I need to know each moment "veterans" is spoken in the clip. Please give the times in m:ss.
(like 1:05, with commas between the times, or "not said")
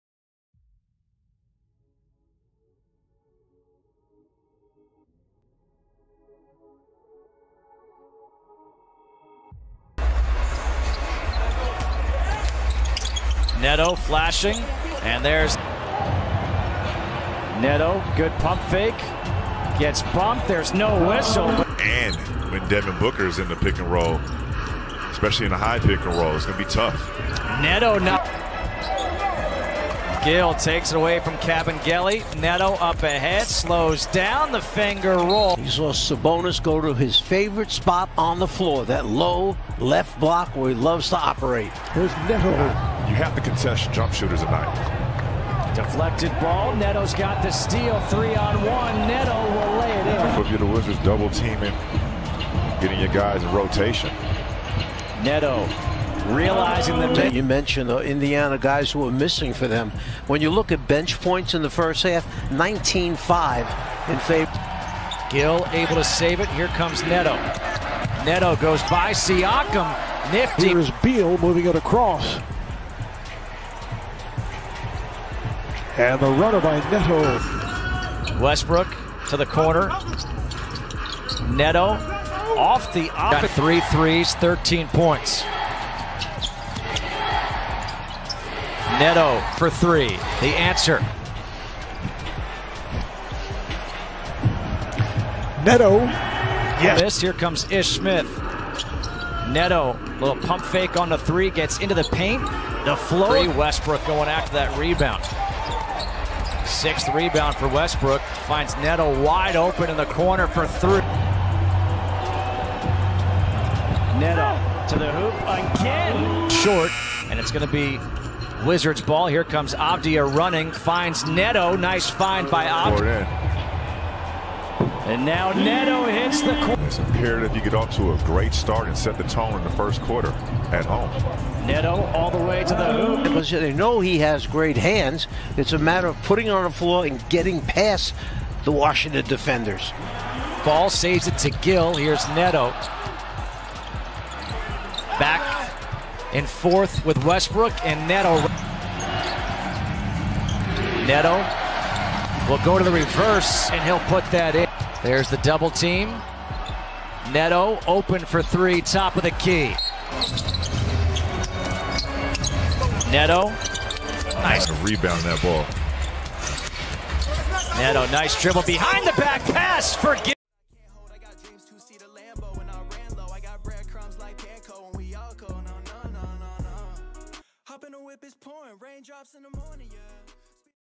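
not said.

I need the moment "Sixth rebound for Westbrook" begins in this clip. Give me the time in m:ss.
1:46.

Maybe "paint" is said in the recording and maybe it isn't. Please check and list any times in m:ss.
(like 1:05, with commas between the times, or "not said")
1:42.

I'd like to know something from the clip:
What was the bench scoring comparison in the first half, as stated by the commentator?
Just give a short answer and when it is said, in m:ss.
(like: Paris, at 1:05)
19-5, at 1:02.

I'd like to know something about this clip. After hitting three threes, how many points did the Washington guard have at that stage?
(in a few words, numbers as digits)
13.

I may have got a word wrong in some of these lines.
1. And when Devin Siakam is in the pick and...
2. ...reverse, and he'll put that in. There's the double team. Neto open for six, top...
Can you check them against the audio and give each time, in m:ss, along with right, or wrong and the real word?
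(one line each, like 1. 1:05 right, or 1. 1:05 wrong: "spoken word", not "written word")
1. 0:21 wrong: "Booker", not "Siakam"
2. 2:32 wrong: "three", not "six".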